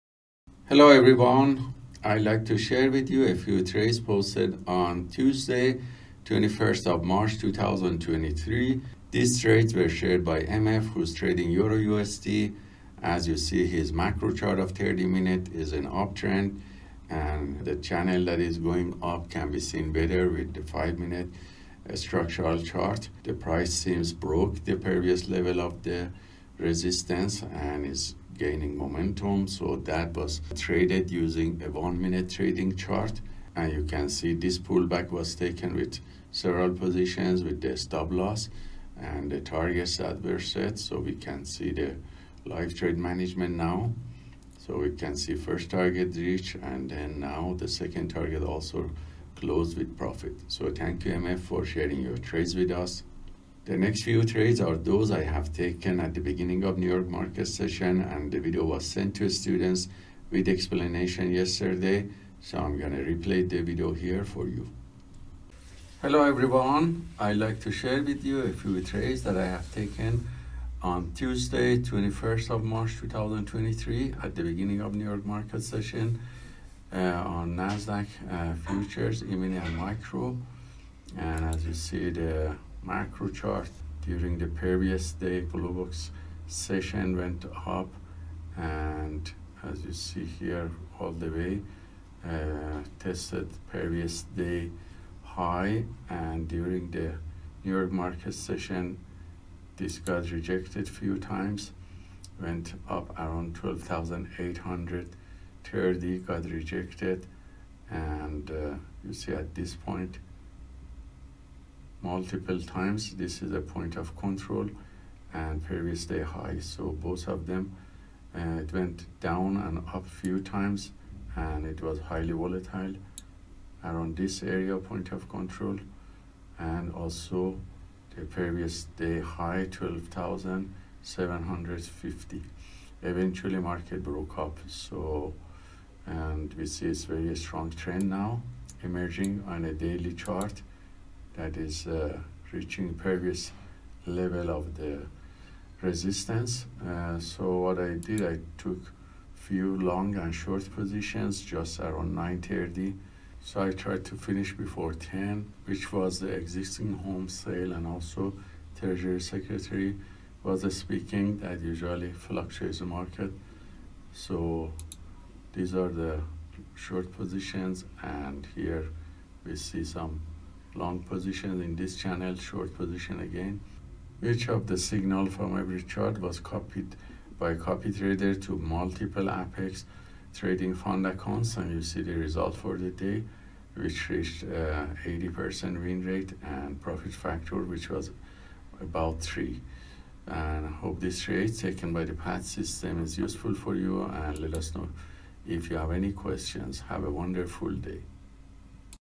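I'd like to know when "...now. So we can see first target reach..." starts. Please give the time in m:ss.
0:43.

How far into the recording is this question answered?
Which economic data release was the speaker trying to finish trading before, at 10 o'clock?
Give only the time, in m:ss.
2:36.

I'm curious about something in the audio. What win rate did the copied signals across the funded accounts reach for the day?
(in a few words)
80%.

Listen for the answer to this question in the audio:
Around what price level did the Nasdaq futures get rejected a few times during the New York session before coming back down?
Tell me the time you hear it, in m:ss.
1:43.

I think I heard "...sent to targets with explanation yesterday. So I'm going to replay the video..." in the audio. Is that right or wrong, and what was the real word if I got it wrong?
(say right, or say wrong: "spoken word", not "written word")
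wrong: "students", not "targets".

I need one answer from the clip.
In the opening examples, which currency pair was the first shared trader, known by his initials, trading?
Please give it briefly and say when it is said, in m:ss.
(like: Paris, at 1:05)
Euro USD, at 0:11.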